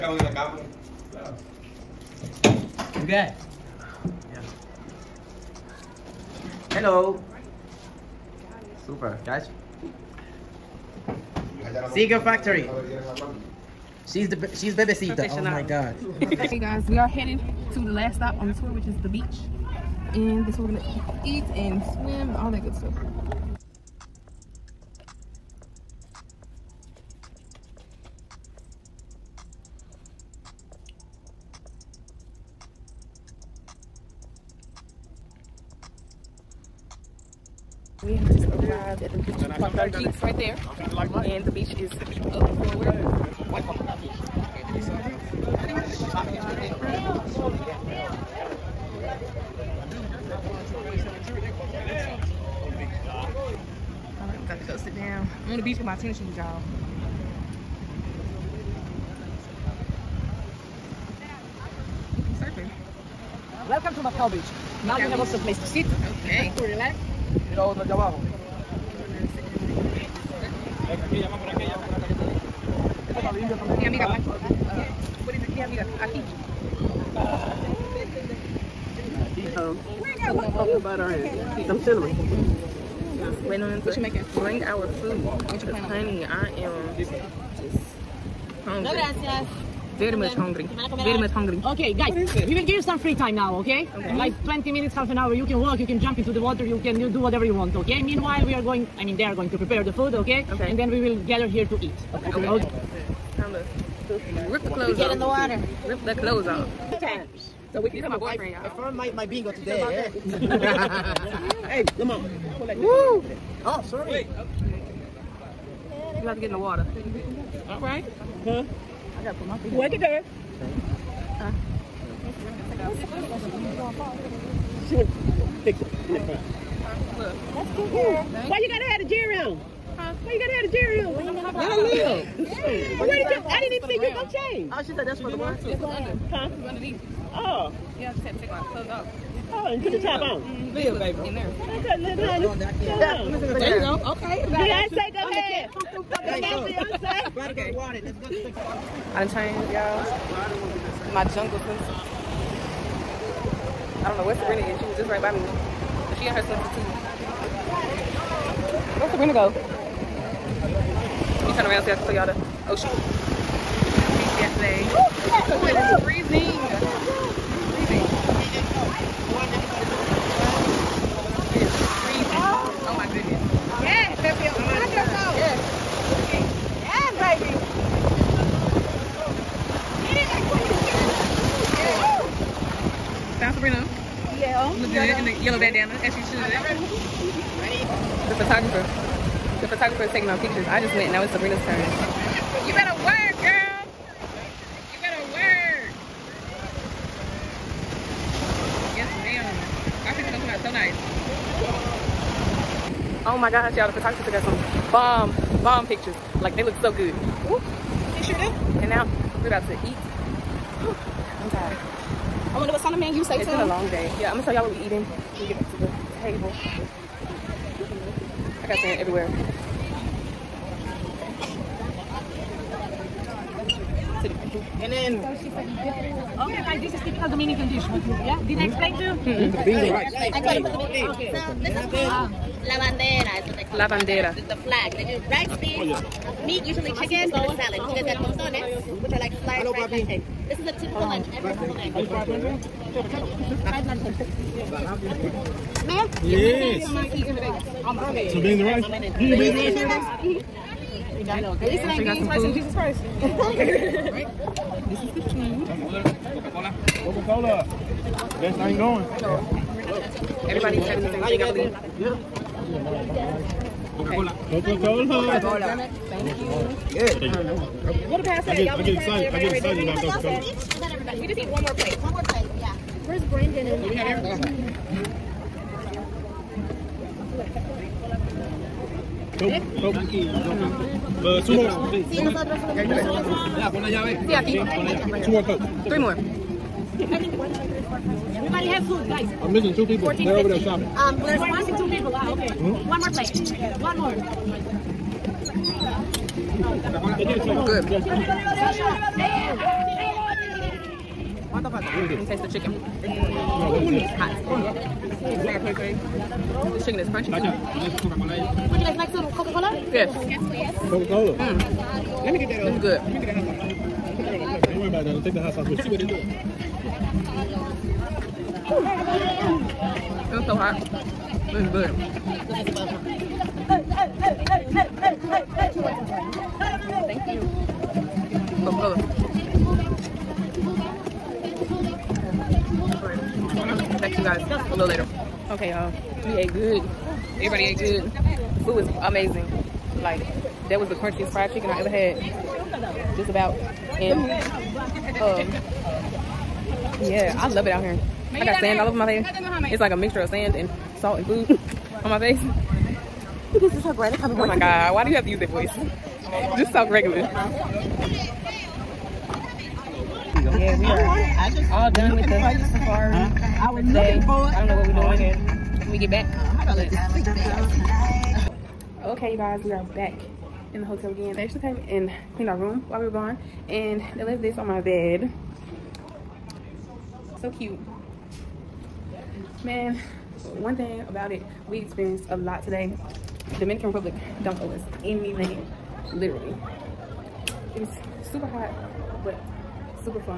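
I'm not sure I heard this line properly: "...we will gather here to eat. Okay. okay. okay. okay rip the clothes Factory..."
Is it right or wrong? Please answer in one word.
wrong.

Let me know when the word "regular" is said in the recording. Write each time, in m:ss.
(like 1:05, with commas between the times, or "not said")
5:56.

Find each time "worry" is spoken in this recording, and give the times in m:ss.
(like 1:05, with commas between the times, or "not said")
5:14.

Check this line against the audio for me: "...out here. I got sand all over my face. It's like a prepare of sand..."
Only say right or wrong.
wrong.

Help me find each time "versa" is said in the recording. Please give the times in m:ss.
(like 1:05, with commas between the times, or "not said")
not said.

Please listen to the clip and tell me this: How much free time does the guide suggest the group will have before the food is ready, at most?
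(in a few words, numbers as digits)
Half an hour.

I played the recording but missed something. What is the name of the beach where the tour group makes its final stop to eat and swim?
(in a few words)
Macao Beach.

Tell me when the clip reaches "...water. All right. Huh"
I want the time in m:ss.
1:56.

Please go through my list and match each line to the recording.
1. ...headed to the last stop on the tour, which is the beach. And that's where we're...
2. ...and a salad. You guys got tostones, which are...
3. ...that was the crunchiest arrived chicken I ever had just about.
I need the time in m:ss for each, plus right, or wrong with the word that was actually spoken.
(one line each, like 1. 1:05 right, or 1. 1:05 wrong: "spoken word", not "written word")
1. 0:17 right
2. 3:57 right
3. 5:40 wrong: "fried", not "arrived".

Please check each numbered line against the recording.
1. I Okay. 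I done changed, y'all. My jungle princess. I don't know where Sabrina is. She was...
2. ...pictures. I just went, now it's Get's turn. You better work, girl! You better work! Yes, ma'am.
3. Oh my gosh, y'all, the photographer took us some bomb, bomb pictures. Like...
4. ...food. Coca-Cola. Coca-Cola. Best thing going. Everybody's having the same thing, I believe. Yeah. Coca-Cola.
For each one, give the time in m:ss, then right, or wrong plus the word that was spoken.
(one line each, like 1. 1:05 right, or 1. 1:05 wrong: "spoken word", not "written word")
1. 2:26 right
2. 3:10 wrong: "Sabrina", not "Get"
3. 3:23 right
4. 4:15 right.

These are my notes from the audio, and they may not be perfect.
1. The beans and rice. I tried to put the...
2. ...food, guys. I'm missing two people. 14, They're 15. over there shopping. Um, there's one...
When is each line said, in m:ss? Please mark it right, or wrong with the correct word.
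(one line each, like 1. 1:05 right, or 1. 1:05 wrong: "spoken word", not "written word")
1. 3:49 right
2. 4:48 right.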